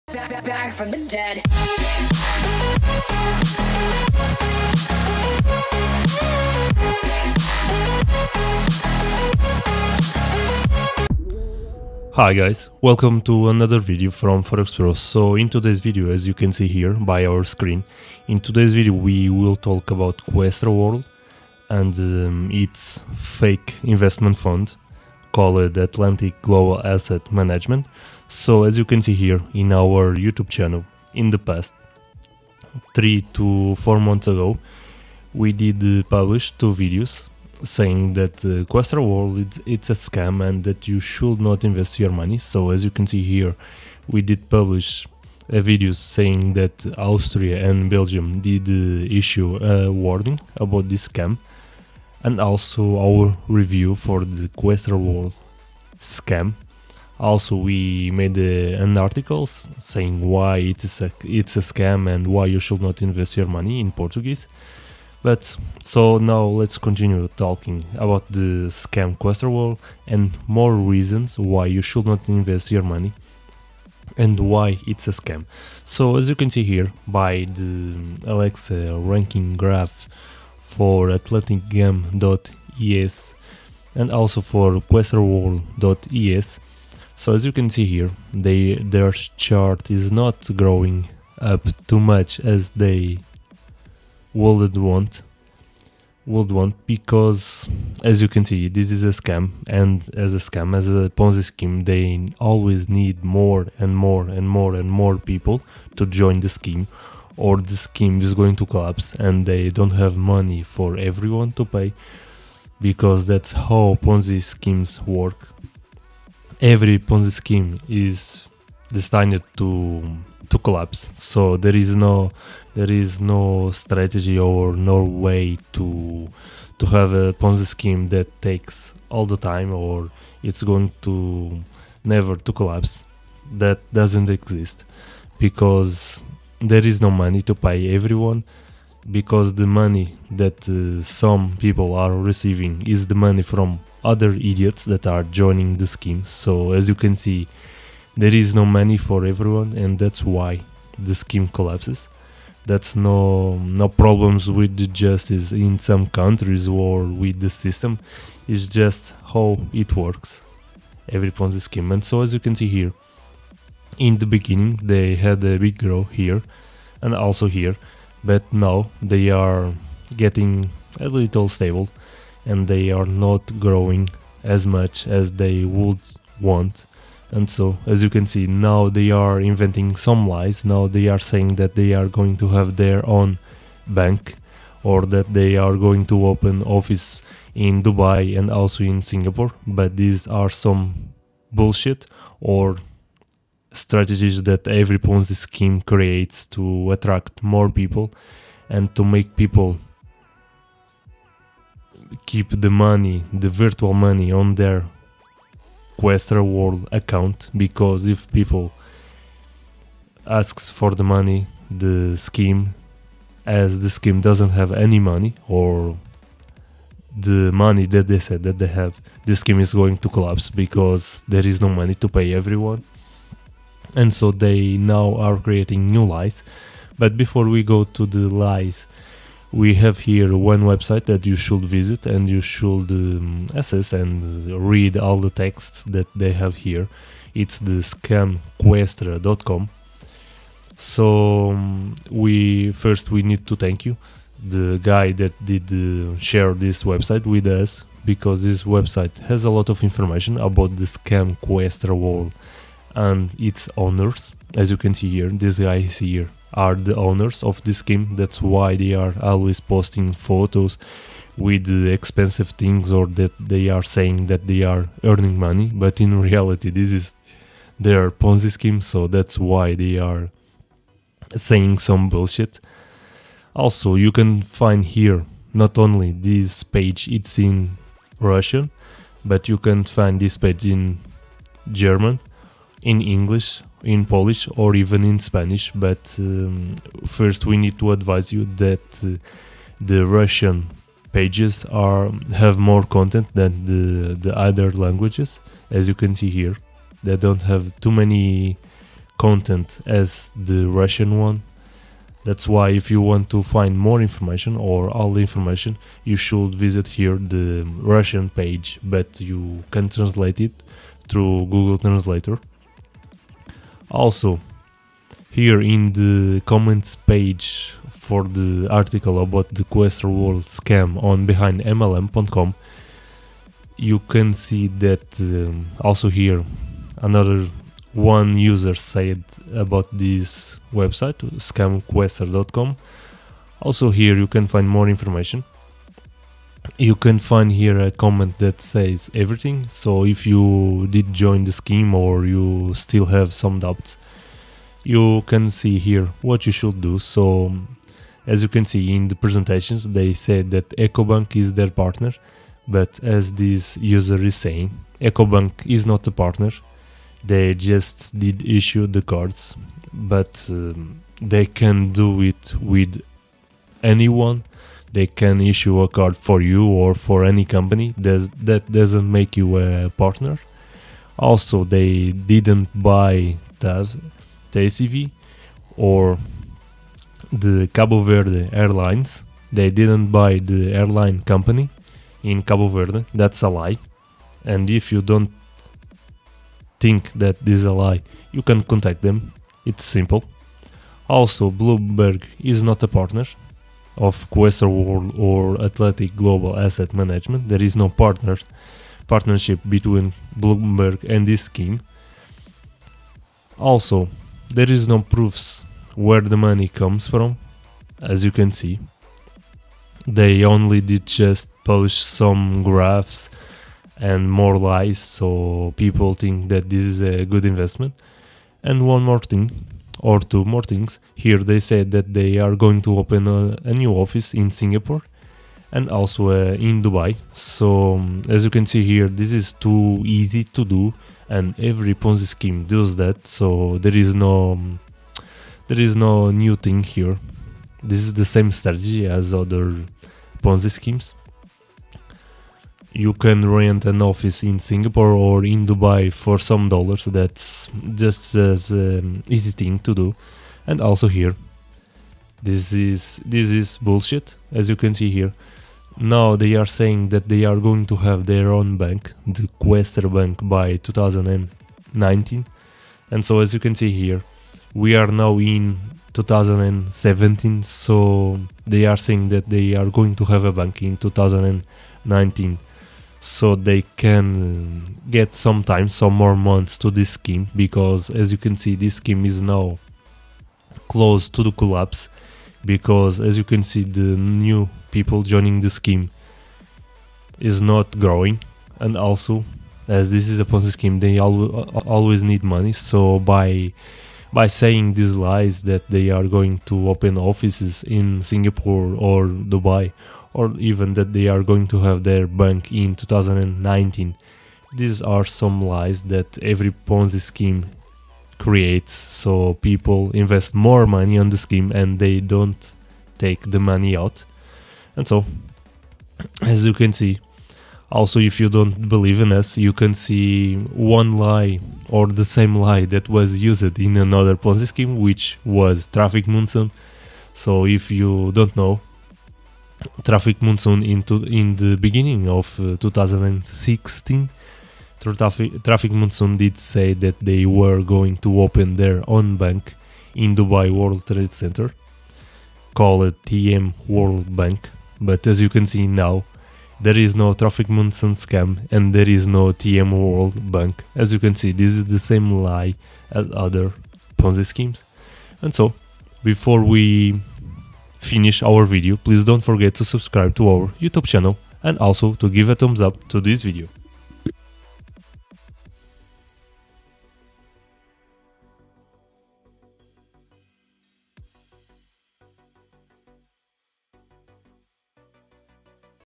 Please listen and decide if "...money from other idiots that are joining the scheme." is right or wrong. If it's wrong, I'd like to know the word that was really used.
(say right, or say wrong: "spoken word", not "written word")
right.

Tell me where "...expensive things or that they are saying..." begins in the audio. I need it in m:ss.
4:21.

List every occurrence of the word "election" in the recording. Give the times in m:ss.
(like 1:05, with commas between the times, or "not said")
not said.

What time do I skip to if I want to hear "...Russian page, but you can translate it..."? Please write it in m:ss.
5:07.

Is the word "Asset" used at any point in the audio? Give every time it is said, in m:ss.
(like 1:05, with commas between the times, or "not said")
0:26, 6:36.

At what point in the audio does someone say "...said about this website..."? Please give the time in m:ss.
5:28.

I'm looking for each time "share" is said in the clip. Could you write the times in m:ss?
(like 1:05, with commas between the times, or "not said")
4:06.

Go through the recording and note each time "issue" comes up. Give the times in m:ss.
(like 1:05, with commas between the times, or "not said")
0:49, 5:58, 6:05.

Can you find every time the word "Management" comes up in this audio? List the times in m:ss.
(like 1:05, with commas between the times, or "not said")
0:27, 6:36.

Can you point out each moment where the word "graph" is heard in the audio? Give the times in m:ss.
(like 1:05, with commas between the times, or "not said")
1:19, 6:52.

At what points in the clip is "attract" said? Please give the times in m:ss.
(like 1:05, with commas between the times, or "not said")
3:16.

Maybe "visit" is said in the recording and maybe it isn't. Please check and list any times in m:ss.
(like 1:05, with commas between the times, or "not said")
3:51, 5:06.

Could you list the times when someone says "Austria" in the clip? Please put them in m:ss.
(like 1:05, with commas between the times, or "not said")
0:46.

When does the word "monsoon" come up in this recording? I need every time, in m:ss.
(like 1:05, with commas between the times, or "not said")
8:46, 8:50, 8:55, 9:07.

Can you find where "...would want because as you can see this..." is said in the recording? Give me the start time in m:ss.
1:36.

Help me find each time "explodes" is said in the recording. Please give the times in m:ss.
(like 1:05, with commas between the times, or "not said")
not said.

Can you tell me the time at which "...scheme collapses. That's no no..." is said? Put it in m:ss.
2:31.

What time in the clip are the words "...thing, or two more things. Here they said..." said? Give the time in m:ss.
6:59.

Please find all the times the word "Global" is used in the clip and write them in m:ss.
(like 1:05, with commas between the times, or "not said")
0:26, 6:36.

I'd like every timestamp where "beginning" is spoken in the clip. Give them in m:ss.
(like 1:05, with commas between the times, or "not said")
2:44, 8:51.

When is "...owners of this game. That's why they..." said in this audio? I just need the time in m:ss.
4:16.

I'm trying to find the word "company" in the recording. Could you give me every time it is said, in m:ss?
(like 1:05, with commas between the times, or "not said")
6:07, 6:21.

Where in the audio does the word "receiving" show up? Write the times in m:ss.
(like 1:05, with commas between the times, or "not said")
2:22.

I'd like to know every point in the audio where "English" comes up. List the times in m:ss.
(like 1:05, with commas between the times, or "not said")
4:43.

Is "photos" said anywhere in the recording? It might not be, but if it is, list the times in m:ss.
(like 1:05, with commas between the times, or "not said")
4:20.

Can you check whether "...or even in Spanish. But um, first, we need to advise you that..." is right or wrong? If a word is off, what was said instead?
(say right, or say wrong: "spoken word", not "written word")
right.